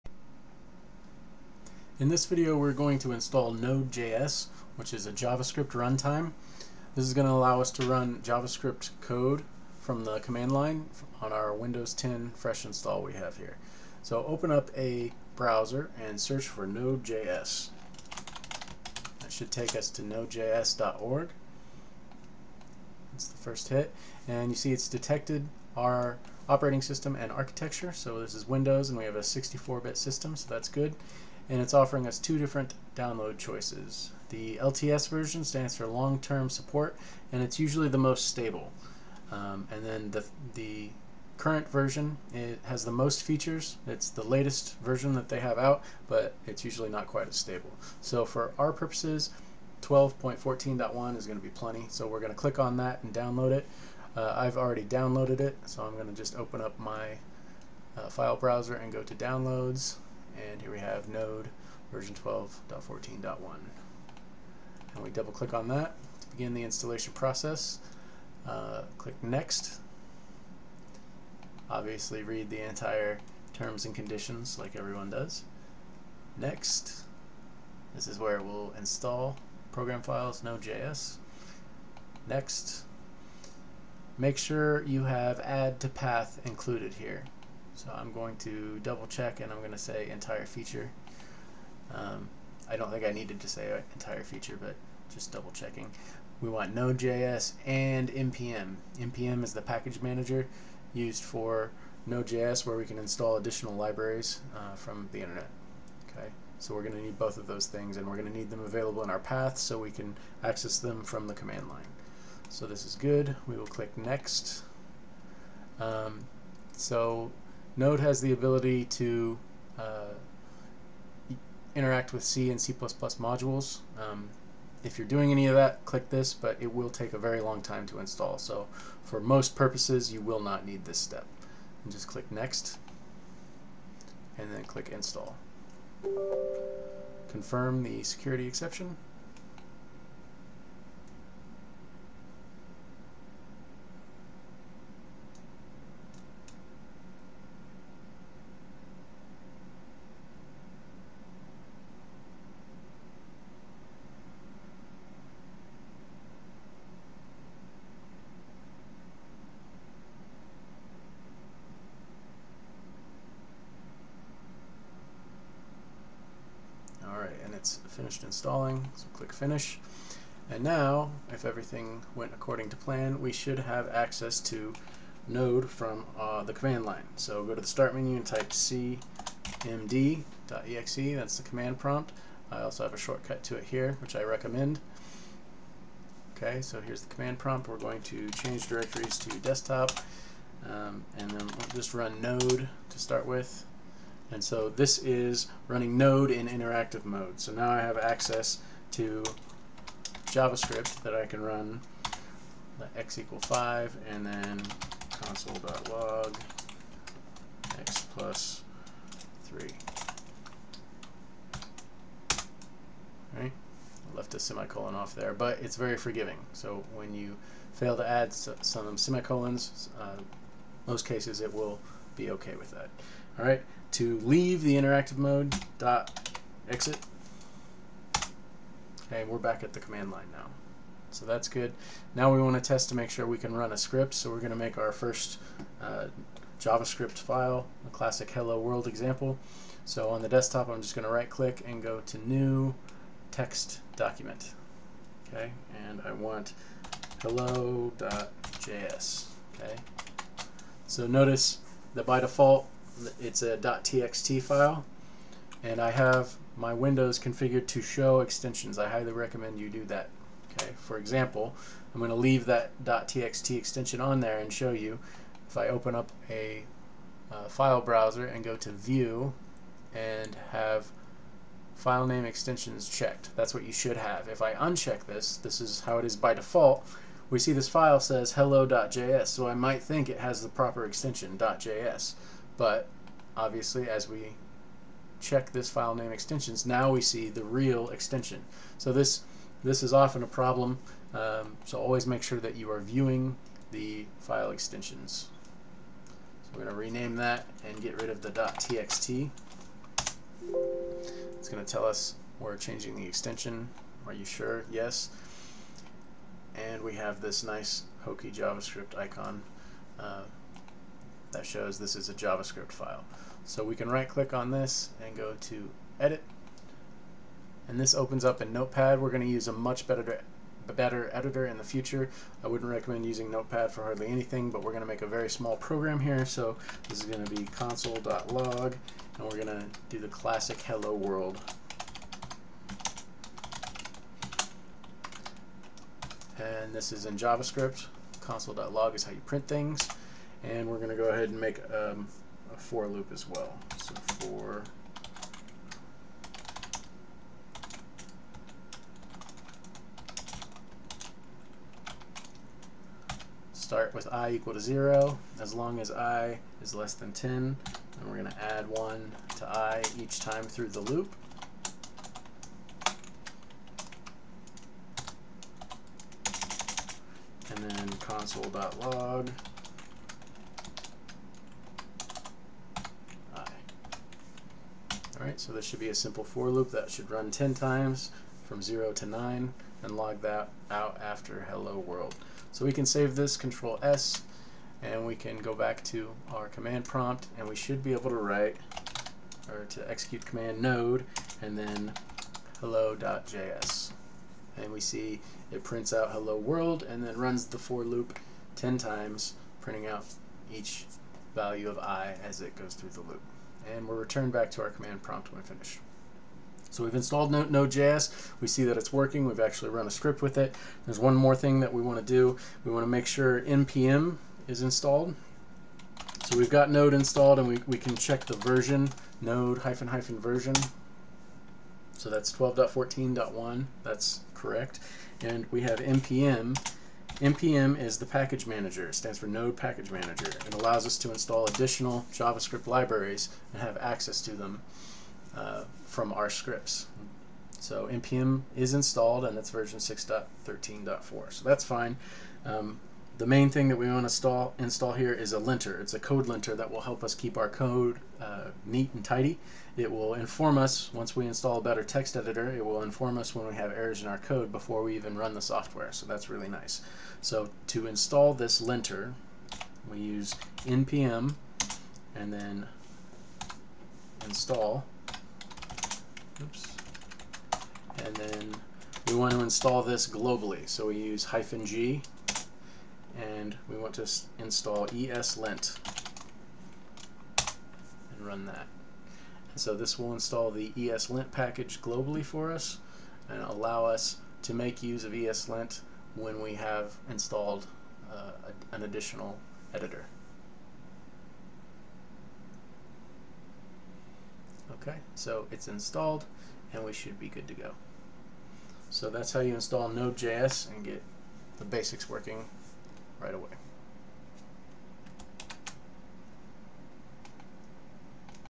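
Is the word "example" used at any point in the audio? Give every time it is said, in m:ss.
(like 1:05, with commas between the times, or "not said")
3:58, 4:20.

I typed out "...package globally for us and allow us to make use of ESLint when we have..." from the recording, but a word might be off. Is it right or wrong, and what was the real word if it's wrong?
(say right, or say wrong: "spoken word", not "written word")
right.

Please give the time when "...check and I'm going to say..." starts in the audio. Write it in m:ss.
1:29.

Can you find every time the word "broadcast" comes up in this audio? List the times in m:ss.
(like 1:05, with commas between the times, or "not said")
not said.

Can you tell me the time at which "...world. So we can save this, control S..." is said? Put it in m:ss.
6:21.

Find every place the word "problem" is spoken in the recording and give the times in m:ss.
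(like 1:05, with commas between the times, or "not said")
4:50.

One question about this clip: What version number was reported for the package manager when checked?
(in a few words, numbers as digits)
6.13.4.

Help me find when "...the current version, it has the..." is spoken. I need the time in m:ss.
0:40.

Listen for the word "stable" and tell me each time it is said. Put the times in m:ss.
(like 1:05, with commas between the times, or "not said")
0:38, 0:47.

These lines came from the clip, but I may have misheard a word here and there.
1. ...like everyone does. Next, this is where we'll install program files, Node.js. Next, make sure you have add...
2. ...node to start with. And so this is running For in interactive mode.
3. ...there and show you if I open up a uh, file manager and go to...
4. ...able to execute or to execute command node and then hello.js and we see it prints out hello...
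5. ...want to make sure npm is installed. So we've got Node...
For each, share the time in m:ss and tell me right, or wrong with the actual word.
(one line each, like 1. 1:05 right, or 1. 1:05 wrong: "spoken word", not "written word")
1. 1:14 right
2. 3:12 wrong: "Node", not "For"
3. 4:24 wrong: "browser", not "manager"
4. 6:27 wrong: "write", not "execute"
5. 6:52 right.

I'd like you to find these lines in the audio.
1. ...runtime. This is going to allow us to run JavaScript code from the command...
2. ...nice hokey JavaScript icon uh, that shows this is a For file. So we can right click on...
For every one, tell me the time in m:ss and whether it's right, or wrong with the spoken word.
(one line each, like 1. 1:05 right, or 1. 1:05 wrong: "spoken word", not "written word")
1. 0:05 right
2. 5:07 wrong: "JavaScript", not "For".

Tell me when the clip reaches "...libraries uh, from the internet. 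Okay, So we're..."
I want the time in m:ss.
1:43.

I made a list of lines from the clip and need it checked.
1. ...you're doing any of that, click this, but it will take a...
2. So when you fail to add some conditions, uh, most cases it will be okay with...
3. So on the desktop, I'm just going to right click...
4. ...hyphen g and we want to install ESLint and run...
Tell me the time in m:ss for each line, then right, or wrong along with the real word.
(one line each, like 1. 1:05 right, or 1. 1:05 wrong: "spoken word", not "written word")
1. 2:04 right
2. 3:36 wrong: "semicolons", not "conditions"
3. 3:59 right
4. 7:51 right.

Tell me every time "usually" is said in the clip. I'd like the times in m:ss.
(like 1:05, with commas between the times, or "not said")
0:37, 0:46.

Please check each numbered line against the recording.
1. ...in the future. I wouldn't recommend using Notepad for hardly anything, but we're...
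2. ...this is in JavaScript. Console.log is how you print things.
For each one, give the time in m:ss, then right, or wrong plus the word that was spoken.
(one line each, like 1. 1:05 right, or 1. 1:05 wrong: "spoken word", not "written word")
1. 5:21 right
2. 5:36 right.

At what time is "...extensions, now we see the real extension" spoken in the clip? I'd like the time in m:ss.
4:46.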